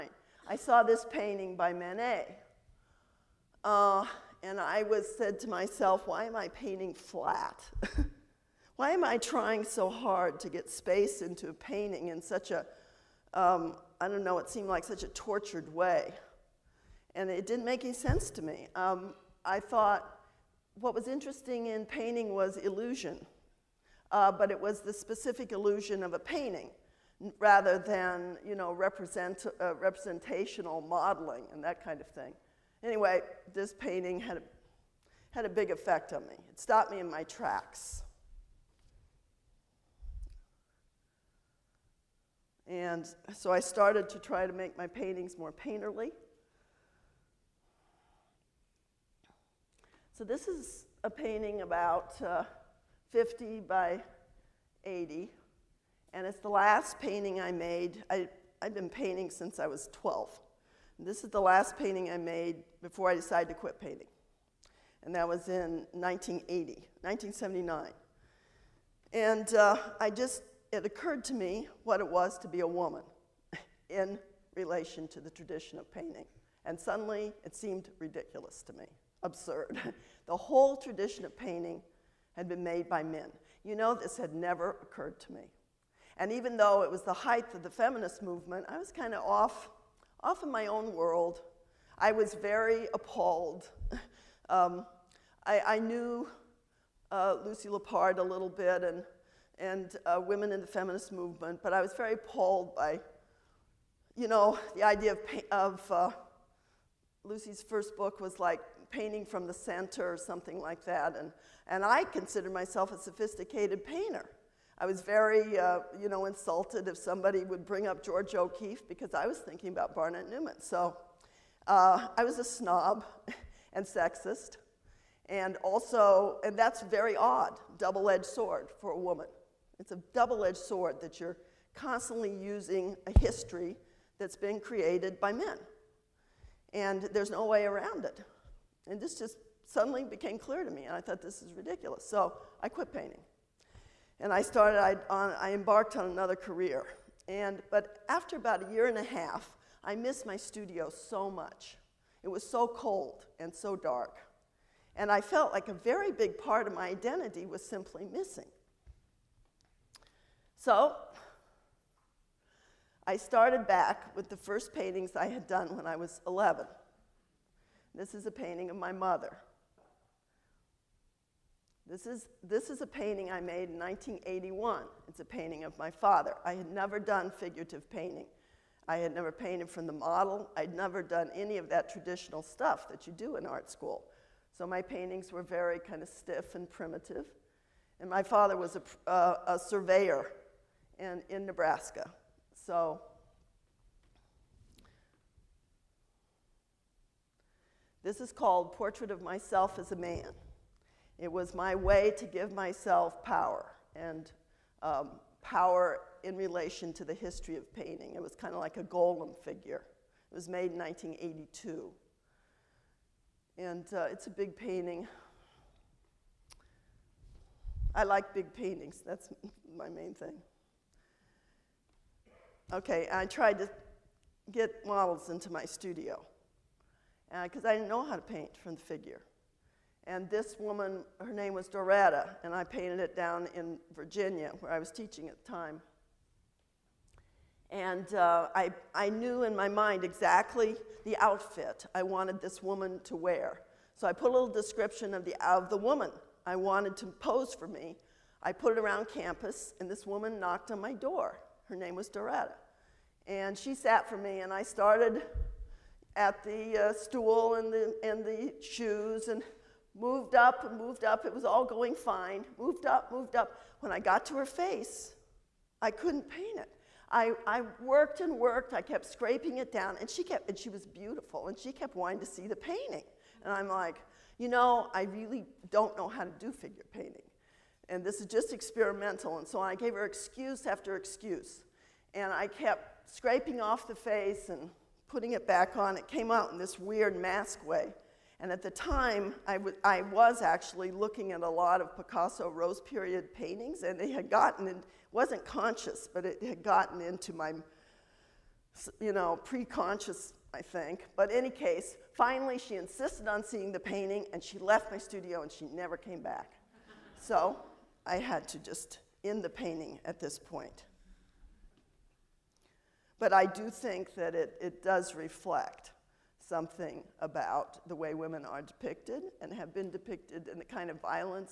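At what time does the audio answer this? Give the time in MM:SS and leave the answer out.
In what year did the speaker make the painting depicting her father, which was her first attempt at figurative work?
02:53.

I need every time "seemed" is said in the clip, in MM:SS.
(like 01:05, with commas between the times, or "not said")
00:14, 01:17.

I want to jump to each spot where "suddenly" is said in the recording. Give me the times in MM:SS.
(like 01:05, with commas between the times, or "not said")
01:16, 02:19.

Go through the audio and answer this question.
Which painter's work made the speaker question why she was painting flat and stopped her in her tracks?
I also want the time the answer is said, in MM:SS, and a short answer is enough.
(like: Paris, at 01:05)
Manet, at 00:01.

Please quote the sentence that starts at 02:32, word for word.
It was so cold and so dark, and I felt like a very big part of my identity was simply missing.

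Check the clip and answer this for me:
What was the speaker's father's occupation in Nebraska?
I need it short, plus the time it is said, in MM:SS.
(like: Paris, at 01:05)
Surveyor, at 03:09.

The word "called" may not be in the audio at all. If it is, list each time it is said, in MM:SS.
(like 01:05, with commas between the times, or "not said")
03:18.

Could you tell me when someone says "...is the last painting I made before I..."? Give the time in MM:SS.
01:01.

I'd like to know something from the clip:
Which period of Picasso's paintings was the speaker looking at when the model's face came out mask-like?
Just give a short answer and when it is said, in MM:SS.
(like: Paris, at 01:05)
Rose period, at 04:52.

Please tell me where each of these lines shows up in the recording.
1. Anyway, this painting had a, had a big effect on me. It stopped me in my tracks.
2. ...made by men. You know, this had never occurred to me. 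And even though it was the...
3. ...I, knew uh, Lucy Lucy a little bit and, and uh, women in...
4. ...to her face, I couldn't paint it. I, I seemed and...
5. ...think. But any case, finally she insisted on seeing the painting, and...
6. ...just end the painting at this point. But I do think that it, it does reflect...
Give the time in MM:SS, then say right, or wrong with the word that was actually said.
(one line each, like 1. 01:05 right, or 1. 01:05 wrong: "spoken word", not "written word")
1. 00:32 right
2. 01:22 right
3. 01:35 wrong: "Lippard", not "Lucy"
4. 04:24 wrong: "worked", not "seemed"
5. 05:00 right
6. 05:08 right.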